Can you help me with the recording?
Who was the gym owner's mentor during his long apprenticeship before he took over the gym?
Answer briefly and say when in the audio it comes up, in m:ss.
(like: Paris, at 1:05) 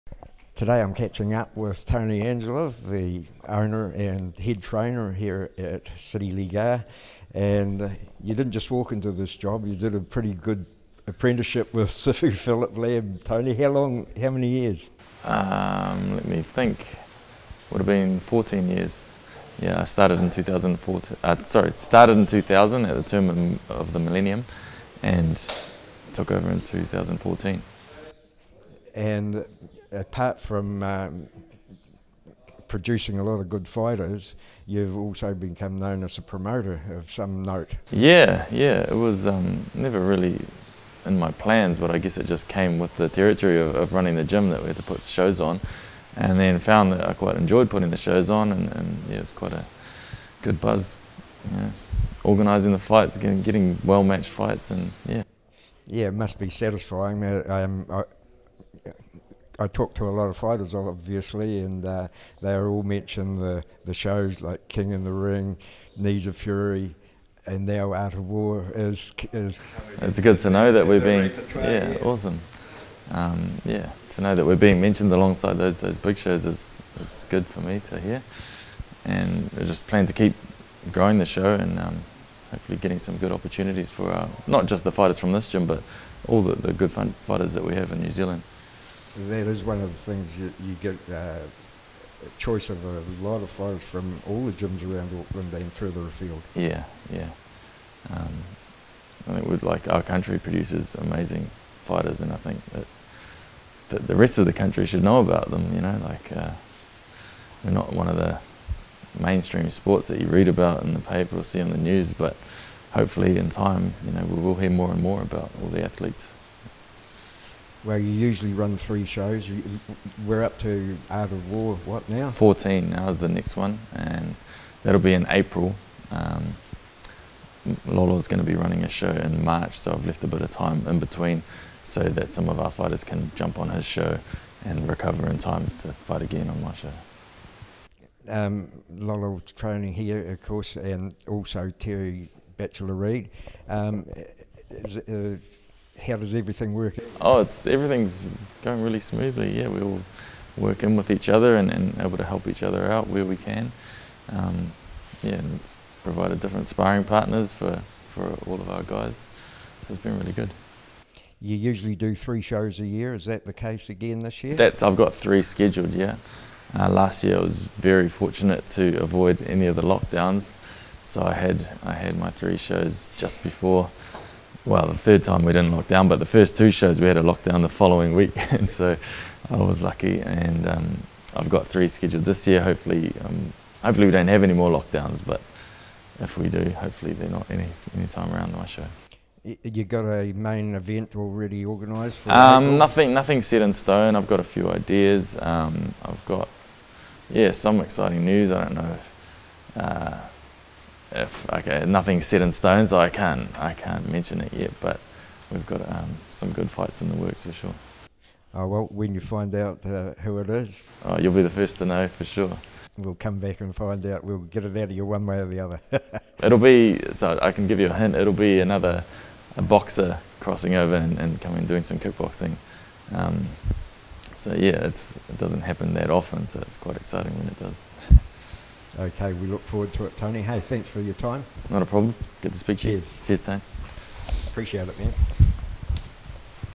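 Sifu Phillip Lam, at 0:11.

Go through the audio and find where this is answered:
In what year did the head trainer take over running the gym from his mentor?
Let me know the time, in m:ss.
0:26.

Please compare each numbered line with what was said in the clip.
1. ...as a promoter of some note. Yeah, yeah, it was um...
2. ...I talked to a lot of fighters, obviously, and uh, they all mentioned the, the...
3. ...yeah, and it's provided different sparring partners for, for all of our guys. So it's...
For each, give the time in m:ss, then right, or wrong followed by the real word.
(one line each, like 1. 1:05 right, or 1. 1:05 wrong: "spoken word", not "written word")
1. 0:36 right
2. 0:59 right
3. 2:35 right.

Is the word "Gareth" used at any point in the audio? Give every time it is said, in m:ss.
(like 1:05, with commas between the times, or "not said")
not said.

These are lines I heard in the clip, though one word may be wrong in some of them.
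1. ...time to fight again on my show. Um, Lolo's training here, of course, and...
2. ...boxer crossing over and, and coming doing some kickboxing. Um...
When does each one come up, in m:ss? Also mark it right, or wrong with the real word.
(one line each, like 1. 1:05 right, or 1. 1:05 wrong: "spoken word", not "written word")
1. 2:15 right
2. 3:39 right.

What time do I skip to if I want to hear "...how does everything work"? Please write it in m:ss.
2:26.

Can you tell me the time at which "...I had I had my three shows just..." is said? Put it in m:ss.
2:51.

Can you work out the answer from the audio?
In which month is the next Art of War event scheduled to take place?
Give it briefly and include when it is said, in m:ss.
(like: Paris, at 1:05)
April, at 2:05.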